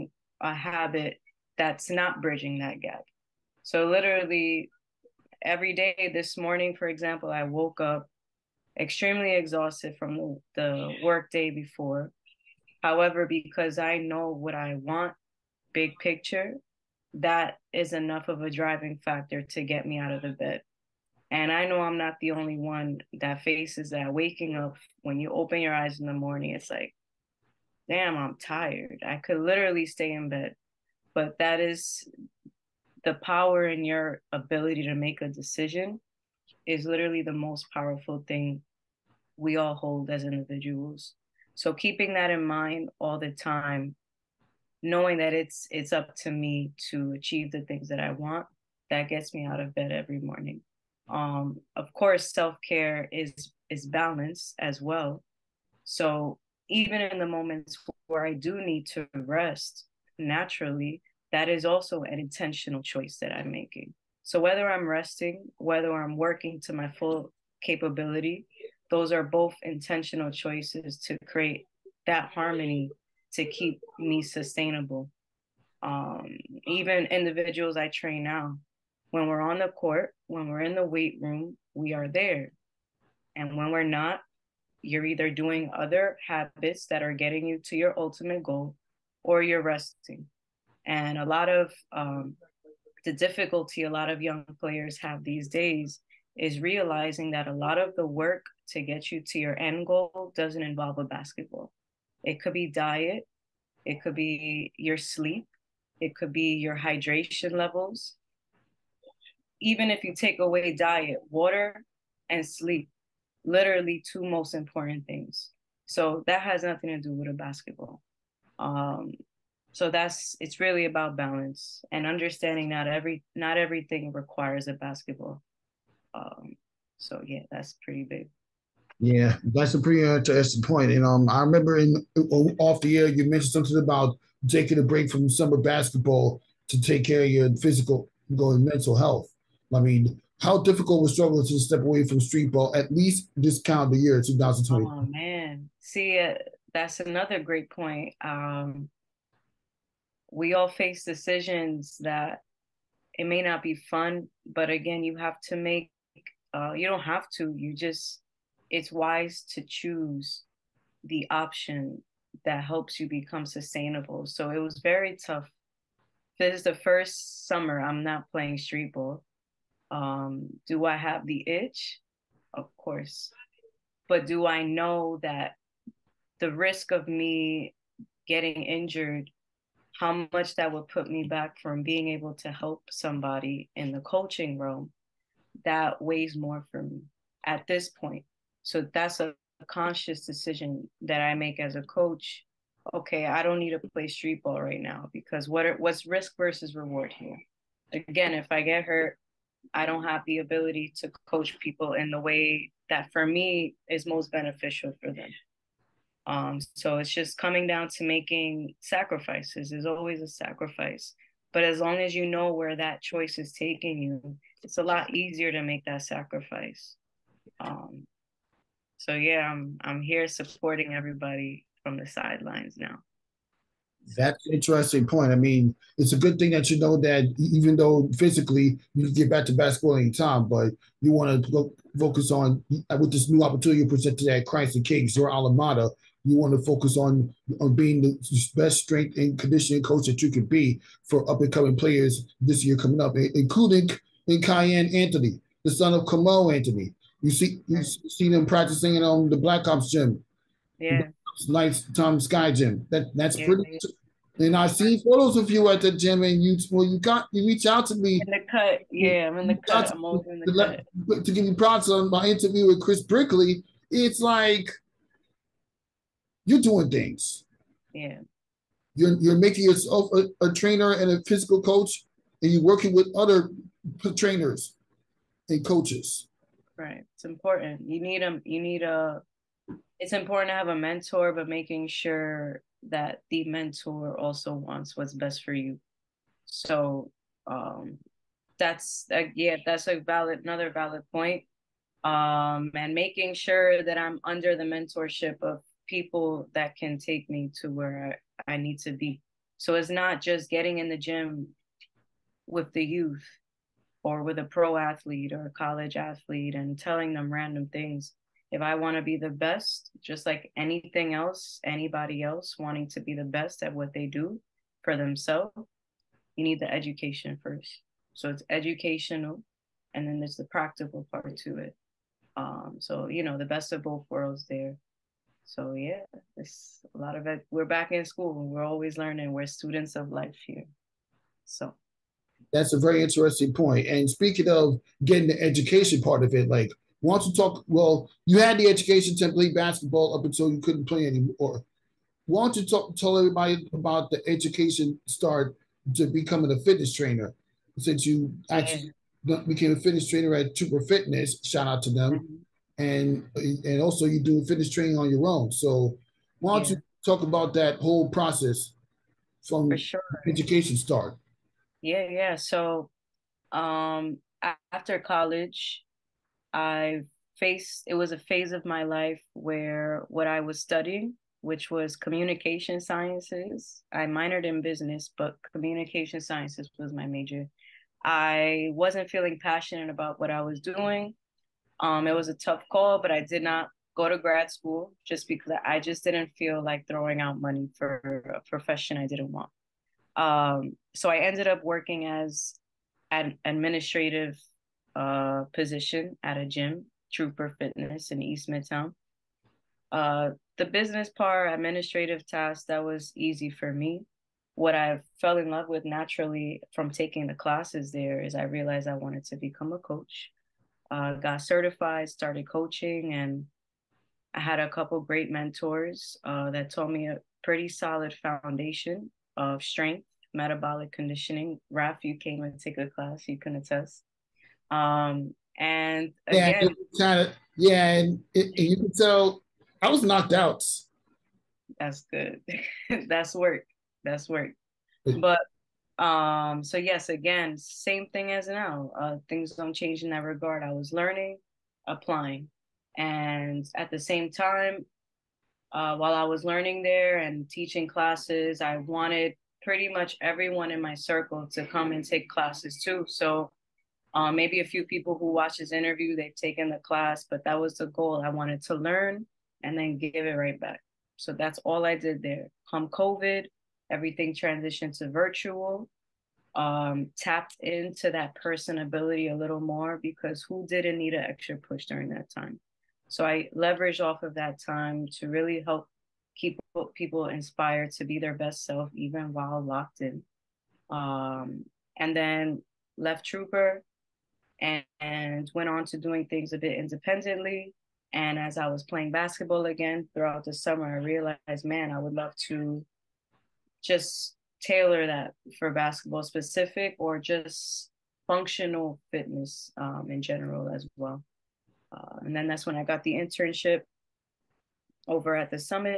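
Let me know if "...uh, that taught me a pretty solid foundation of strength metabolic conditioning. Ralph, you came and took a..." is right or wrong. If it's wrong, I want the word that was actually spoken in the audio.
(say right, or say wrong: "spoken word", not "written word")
right.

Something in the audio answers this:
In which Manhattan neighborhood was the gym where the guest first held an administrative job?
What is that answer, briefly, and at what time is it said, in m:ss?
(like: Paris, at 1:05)
East Midtown, at 6:38.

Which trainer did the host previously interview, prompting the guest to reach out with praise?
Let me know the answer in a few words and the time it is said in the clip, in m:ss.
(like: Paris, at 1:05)
Chris Brickley, at 4:22.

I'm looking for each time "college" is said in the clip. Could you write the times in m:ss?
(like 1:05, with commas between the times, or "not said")
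5:05, 6:04.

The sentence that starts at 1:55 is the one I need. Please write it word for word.
So that has nothing to do with a basketball.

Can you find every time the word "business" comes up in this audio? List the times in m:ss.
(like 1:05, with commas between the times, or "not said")
6:14, 6:40.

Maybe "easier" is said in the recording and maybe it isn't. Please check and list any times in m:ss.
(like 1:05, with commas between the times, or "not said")
3:35.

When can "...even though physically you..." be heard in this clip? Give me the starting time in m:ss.
3:47.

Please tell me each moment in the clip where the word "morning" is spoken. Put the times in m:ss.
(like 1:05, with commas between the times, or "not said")
0:06, 0:26, 0:50.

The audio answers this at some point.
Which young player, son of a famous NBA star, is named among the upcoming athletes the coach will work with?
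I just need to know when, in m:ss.
4:04.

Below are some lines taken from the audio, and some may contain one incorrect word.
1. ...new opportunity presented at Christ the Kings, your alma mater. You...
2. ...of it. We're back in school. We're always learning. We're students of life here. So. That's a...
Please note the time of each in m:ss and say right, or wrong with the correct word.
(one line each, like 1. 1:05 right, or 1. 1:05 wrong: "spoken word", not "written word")
1. 3:53 right
2. 5:27 right.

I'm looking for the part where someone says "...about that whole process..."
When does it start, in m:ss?
5:57.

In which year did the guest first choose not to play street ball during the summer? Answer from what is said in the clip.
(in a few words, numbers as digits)
2020.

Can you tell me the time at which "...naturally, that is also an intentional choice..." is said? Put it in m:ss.
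1:00.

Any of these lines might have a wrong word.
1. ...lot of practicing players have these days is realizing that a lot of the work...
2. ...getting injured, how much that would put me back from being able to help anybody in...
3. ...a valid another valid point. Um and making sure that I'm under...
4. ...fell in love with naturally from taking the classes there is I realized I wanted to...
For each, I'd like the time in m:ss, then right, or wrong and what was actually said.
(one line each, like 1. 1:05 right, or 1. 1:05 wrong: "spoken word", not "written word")
1. 1:33 wrong: "young", not "practicing"
2. 2:58 wrong: "somebody", not "anybody"
3. 4:49 right
4. 6:45 right.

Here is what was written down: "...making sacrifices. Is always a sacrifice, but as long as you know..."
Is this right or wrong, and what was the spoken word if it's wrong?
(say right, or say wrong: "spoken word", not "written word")
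right.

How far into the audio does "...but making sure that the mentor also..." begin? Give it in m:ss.
4:41.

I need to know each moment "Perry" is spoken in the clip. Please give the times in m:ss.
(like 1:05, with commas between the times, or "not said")
not said.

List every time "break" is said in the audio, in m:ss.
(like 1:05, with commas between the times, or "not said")
2:14.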